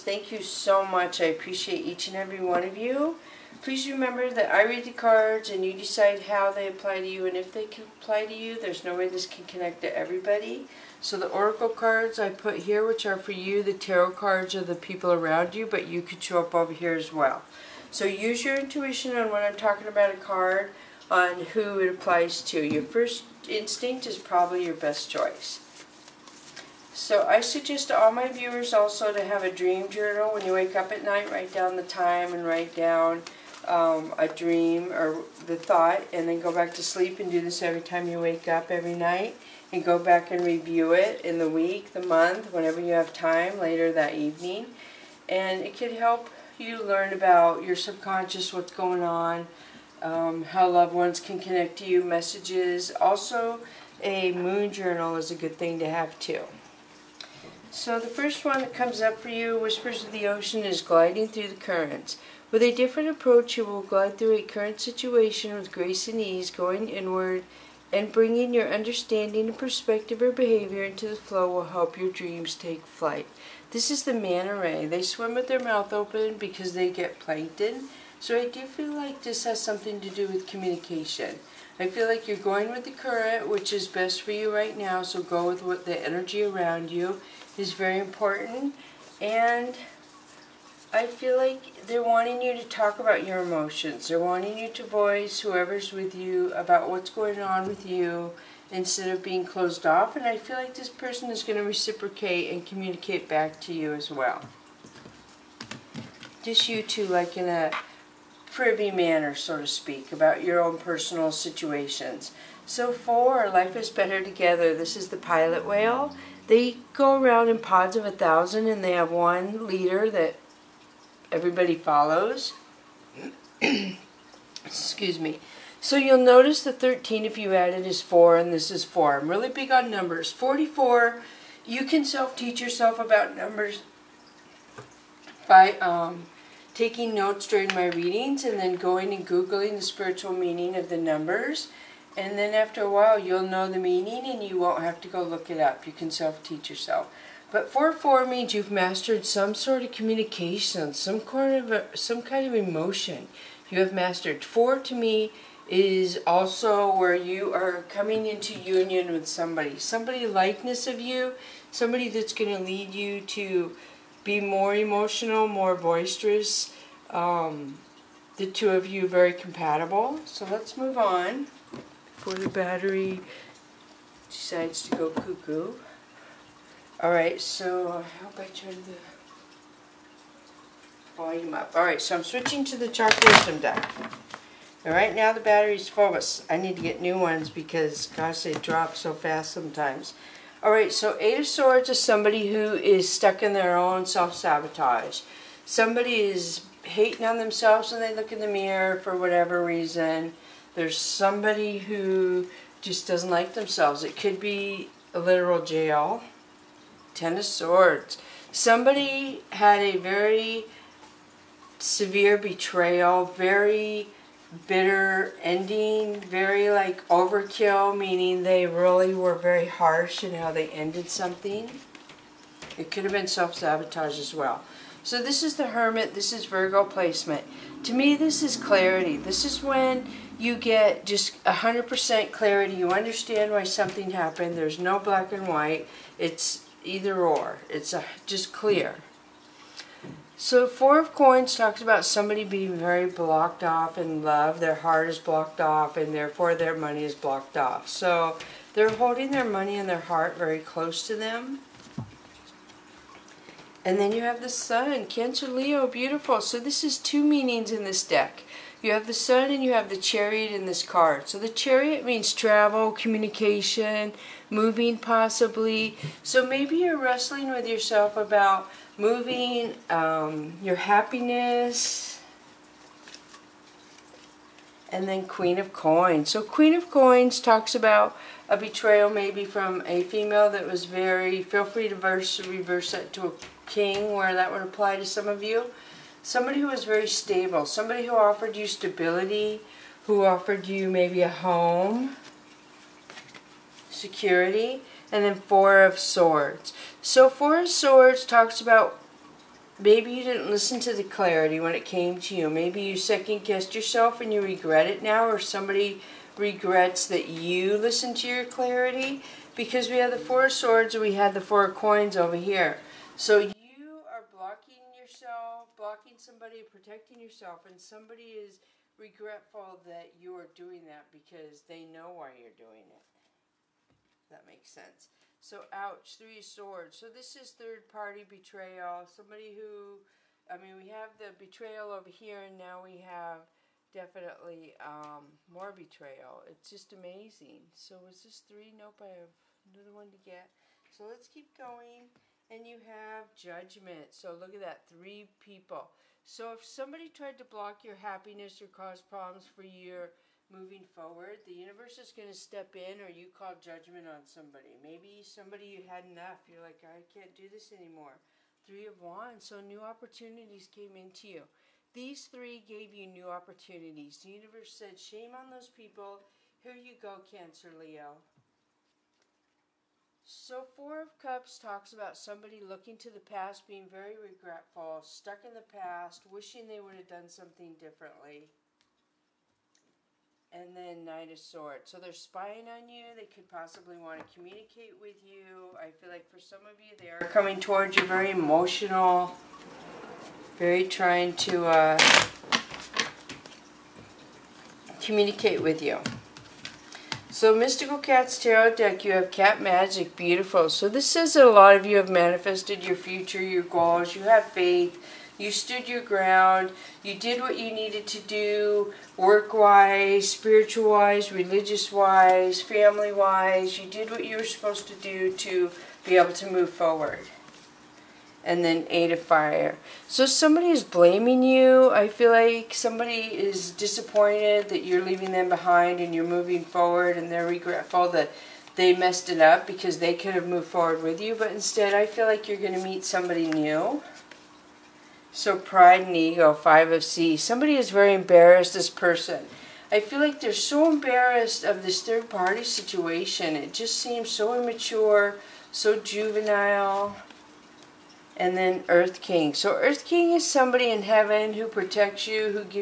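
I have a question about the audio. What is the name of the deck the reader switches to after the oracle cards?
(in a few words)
Chakra Wisdom.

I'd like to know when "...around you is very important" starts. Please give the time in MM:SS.
01:26.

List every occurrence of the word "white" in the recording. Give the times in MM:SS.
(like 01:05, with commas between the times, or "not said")
03:55.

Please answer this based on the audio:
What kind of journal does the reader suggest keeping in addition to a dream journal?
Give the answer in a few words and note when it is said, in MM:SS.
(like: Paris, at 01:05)
Moon journal, at 00:54.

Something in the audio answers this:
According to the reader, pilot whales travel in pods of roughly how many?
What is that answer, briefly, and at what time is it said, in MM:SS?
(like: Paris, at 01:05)
1000, at 01:58.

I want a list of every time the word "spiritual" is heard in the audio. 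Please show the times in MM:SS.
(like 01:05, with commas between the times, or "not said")
02:19, 06:50.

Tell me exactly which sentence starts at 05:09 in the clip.
Because we had the Four of Swords and we had the Four of Coins over here.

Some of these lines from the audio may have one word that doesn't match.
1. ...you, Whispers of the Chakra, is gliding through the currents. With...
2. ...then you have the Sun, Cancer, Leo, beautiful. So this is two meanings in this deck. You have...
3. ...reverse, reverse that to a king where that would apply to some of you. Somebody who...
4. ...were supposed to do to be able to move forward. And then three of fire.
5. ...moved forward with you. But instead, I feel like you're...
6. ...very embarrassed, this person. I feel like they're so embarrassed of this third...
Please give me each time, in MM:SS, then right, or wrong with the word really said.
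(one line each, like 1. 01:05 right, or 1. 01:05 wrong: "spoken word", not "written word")
1. 00:59 wrong: "Ocean", not "Chakra"
2. 04:13 right
3. 04:41 wrong: "verse", not "reverse"
4. 06:54 wrong: "eight", not "three"
5. 07:10 right
6. 07:17 right.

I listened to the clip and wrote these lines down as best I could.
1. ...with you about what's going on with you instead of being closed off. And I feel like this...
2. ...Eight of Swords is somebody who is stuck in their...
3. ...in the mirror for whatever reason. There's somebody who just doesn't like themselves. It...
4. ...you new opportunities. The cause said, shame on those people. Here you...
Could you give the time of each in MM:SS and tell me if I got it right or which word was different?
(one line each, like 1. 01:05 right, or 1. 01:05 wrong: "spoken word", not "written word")
1. 01:35 right
2. 03:11 right
3. 03:18 right
4. 06:02 wrong: "universe", not "cause".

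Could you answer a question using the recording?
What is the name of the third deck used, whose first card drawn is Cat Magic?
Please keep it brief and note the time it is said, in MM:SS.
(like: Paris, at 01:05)
Mystical Cat's Tarot, at 06:37.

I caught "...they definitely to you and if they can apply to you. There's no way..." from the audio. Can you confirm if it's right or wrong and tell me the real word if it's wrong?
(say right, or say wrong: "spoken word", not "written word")
wrong: "apply", not "definitely".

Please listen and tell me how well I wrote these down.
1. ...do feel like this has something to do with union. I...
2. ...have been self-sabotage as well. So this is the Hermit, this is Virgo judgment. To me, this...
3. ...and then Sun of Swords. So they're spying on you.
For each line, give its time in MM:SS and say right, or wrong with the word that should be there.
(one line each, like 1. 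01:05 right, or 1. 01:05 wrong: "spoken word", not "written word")
1. 01:18 wrong: "communication", not "union"
2. 03:43 wrong: "placement", not "judgment"
3. 06:20 wrong: "Knight", not "Sun".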